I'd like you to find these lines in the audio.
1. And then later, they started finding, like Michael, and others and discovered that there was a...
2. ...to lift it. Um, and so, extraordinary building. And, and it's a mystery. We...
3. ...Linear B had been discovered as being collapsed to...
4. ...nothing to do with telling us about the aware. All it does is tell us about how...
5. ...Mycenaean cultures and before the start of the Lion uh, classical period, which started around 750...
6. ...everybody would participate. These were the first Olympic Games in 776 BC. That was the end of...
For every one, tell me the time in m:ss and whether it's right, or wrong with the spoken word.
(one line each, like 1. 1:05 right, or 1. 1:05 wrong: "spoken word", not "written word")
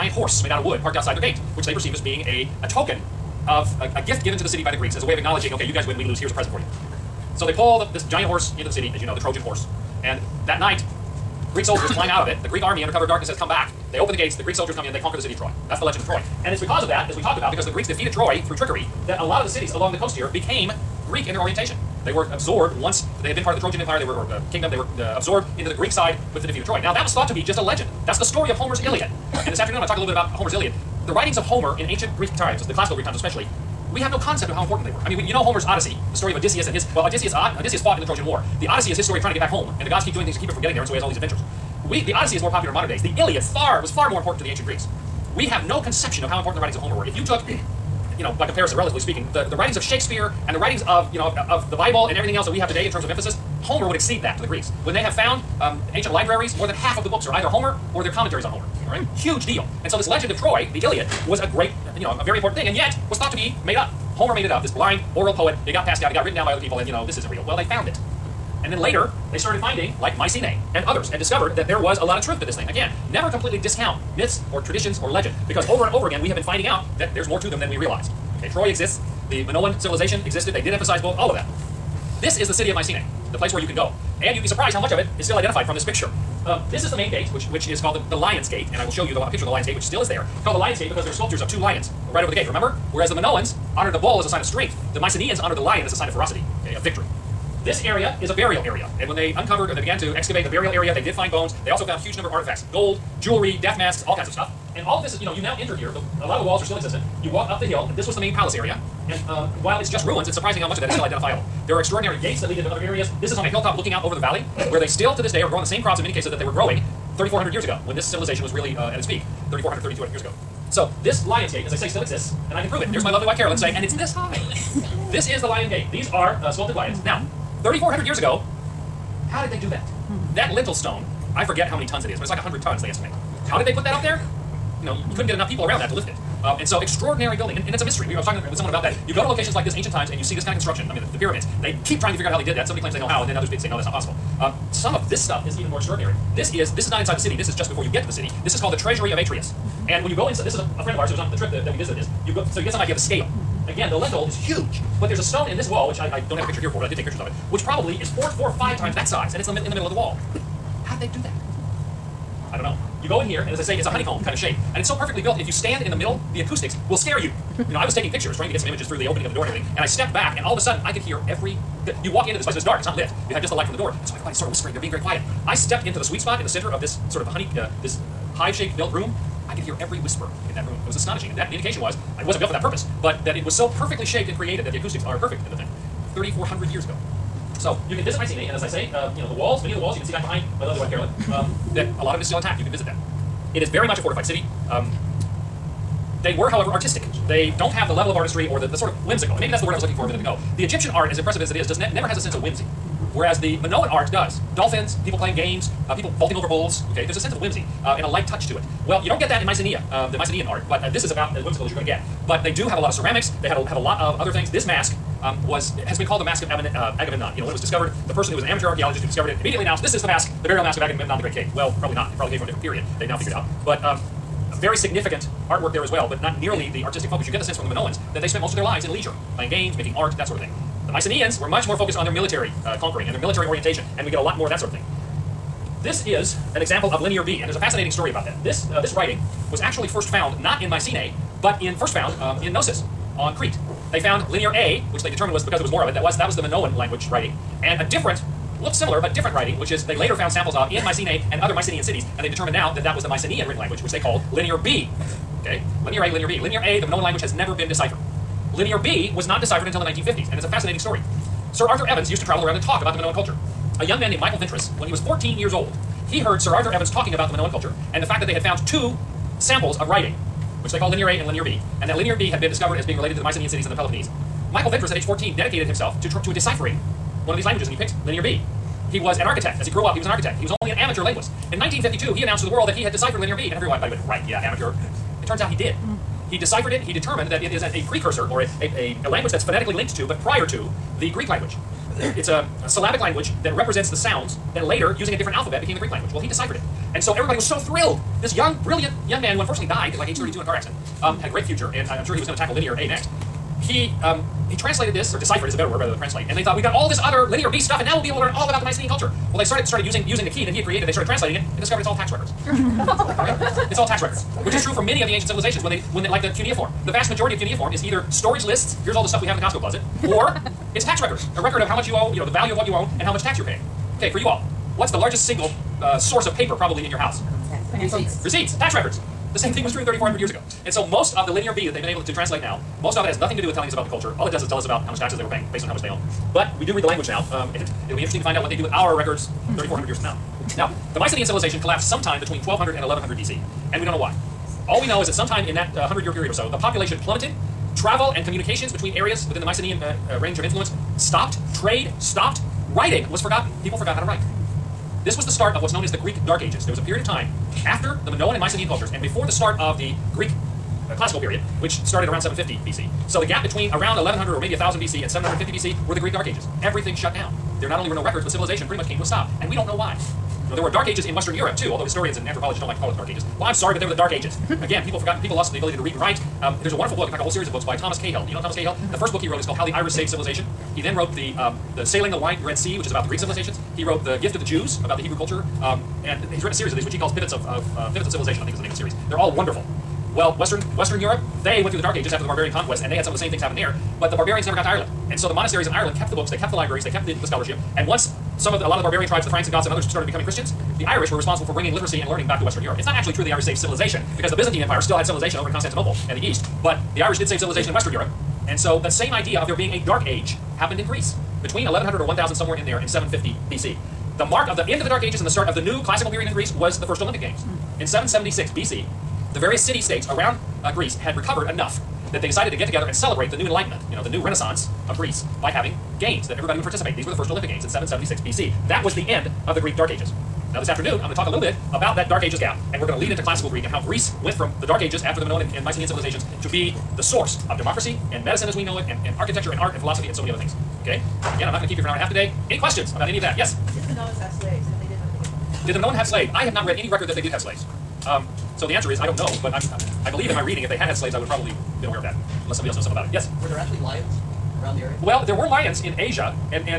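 1. 1:08 wrong: "Mycenae", not "Michael"
2. 2:15 right
3. 4:31 wrong: "related", not "collapsed"
4. 5:33 wrong: "culture", not "aware"
5. 5:58 wrong: "Greek", not "Lion"
6. 7:06 right.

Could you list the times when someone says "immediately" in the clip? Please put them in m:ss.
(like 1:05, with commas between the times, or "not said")
3:39.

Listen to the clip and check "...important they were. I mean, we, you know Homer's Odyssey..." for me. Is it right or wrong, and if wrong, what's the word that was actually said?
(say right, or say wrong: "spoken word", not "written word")
right.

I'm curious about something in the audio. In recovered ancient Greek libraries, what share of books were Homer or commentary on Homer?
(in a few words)
more than half.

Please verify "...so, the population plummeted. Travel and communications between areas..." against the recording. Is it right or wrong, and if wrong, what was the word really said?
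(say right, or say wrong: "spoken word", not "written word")
right.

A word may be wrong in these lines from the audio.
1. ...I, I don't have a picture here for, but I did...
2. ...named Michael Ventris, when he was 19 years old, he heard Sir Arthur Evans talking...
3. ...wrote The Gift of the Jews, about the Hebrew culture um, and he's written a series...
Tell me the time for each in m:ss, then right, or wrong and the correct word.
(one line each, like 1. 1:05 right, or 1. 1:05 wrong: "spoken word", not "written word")
1. 2:35 right
2. 4:24 wrong: "14", not "19"
3. 6:23 right.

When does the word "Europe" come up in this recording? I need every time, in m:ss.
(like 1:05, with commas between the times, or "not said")
6:11, 6:30, 6:42, 6:47.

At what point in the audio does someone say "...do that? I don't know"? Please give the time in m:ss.
2:41.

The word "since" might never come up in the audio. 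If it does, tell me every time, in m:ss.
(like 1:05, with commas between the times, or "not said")
not said.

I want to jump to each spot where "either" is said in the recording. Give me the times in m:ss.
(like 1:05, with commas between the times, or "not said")
0:57, 5:17.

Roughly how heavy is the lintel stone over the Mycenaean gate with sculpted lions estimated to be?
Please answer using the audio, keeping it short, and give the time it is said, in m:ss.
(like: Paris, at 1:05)
100 tons, at 2:12.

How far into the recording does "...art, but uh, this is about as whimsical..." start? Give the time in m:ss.
3:30.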